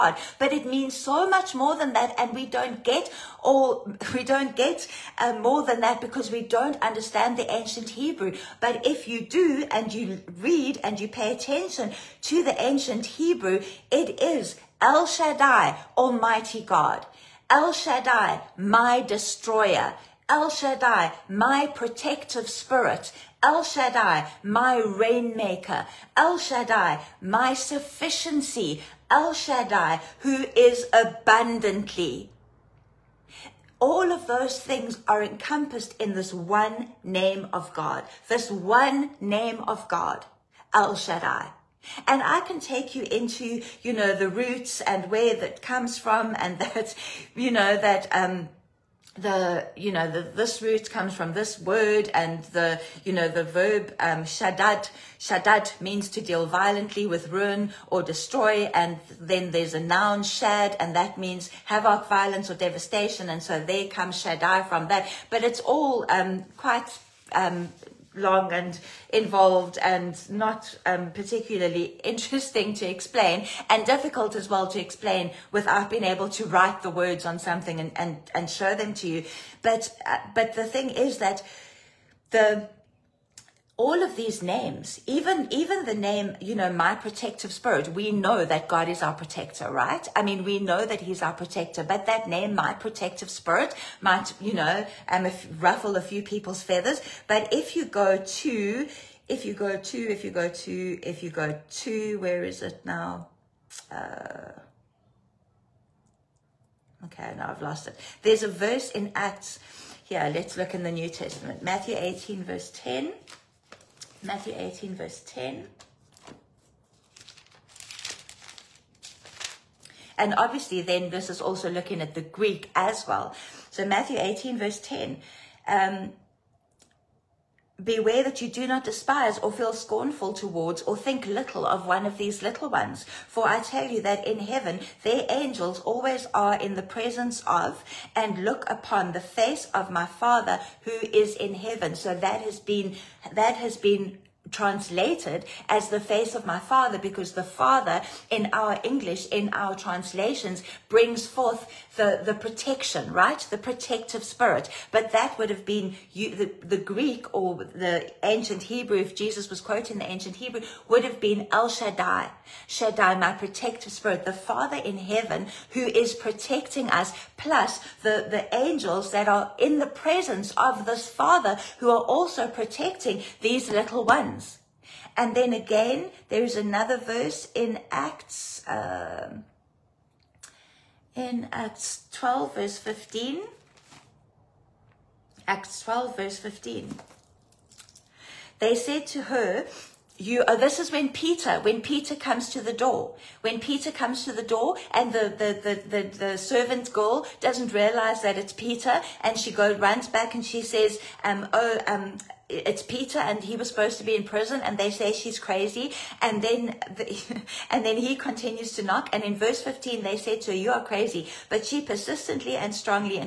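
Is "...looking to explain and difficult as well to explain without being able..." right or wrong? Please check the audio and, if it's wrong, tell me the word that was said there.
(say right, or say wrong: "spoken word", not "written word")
wrong: "interesting", not "looking".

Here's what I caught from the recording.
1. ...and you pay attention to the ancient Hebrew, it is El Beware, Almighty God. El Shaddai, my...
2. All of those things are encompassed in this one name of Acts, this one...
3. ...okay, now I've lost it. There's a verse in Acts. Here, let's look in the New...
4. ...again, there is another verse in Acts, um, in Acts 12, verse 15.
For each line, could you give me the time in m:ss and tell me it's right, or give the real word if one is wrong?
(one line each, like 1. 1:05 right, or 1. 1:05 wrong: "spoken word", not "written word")
1. 0:10 wrong: "Shaddai", not "Beware"
2. 0:33 wrong: "God", not "Acts"
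3. 1:47 right
4. 2:55 right.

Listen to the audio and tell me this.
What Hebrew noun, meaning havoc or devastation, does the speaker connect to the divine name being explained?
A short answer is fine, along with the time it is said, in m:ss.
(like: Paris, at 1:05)
shad, at 1:00.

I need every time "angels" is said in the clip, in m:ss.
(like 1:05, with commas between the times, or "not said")
2:15, 2:48.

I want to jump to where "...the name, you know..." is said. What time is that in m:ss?
1:25.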